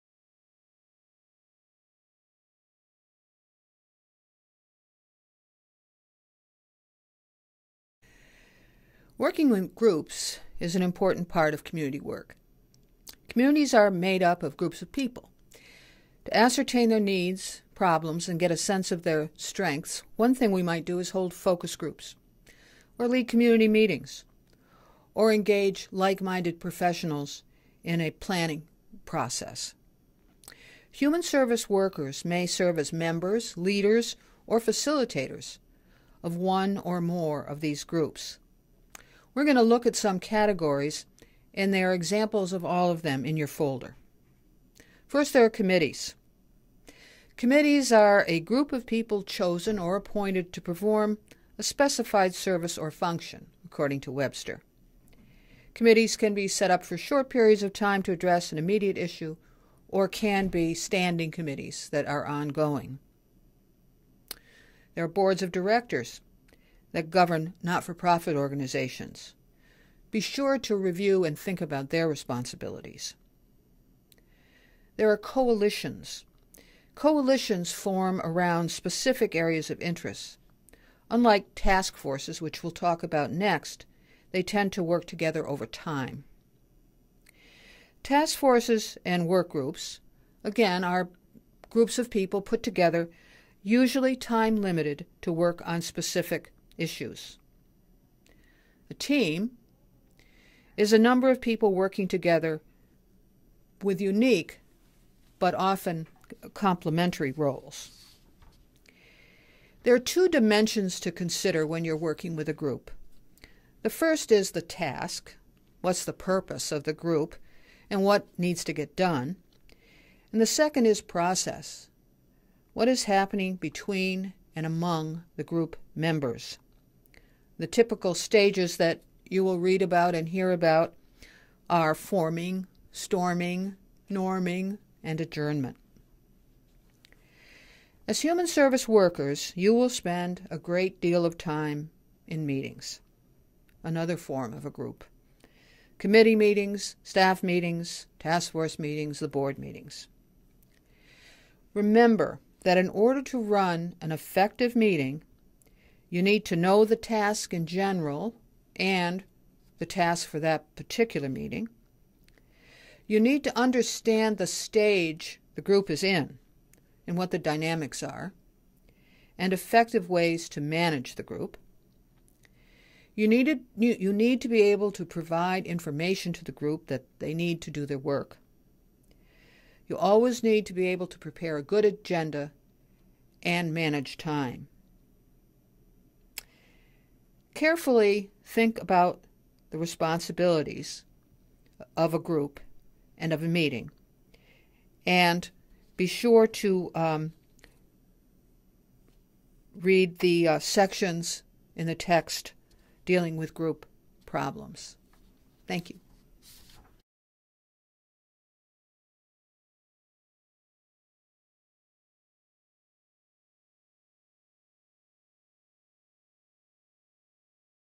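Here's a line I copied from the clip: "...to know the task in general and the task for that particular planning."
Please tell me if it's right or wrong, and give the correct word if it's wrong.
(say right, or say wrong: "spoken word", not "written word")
wrong: "meeting", not "planning".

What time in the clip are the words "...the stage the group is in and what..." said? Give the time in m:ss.
2:44.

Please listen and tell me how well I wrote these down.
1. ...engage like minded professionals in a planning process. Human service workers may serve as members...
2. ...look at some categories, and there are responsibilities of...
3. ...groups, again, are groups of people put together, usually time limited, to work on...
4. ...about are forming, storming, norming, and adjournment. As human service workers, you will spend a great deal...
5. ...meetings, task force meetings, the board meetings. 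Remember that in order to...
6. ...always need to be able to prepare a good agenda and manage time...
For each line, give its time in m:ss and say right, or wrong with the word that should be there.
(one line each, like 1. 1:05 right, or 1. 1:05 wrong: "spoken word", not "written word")
1. 0:25 right
2. 0:39 wrong: "examples", not "responsibilities"
3. 1:29 right
4. 2:10 right
5. 2:27 right
6. 2:59 right.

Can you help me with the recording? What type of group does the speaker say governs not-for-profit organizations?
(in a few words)
Boards of directors.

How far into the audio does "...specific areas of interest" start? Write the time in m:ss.
1:18.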